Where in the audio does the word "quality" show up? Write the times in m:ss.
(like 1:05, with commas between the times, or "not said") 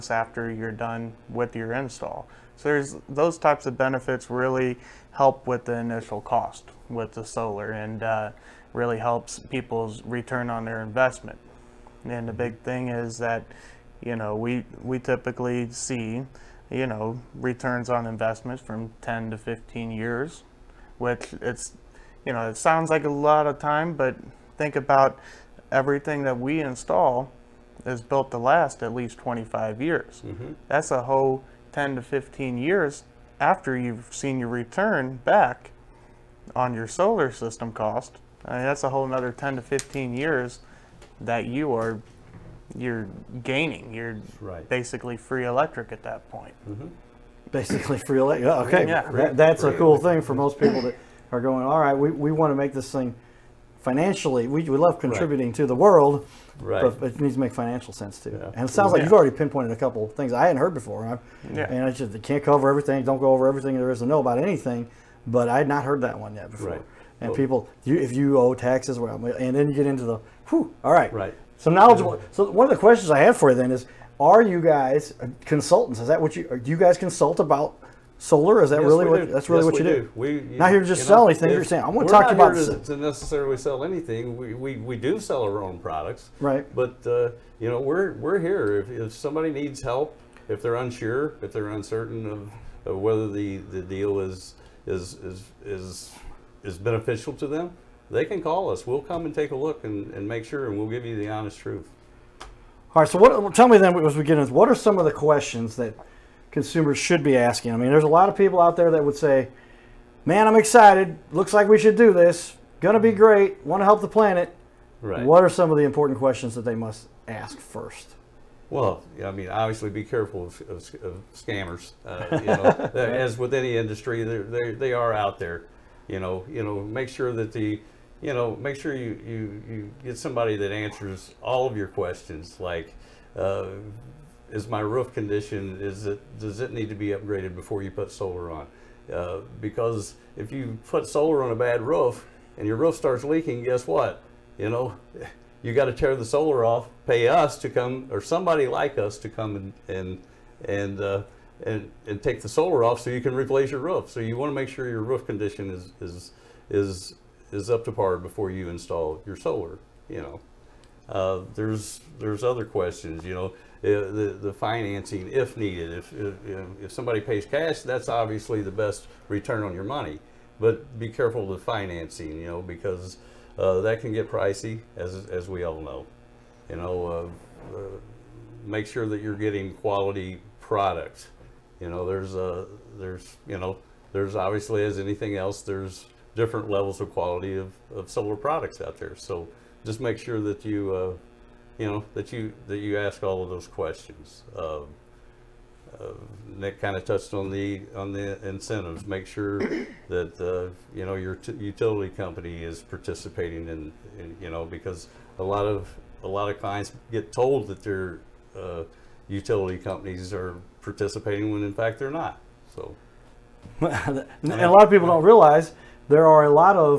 2:59, 3:07.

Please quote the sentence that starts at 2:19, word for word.
Uh, because if you put solar on a bad roof and your roof starts leaking, guess what?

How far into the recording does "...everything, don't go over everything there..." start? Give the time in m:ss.
1:02.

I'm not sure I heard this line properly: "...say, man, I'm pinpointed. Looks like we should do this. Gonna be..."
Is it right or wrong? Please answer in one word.
wrong.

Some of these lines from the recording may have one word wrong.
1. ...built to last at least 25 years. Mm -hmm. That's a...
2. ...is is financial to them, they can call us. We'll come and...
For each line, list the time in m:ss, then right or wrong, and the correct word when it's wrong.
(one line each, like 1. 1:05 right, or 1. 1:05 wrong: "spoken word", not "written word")
1. 0:28 right
2. 1:35 wrong: "beneficial", not "financial".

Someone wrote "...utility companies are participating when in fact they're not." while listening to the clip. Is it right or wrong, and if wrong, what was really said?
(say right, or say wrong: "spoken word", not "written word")
right.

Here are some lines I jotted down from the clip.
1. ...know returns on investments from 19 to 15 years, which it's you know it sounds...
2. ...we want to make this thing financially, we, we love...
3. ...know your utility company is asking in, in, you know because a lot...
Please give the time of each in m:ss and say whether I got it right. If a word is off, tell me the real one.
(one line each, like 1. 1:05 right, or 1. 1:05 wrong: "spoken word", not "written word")
1. 0:16 wrong: "10", not "19"
2. 0:52 right
3. 3:21 wrong: "participating", not "asking".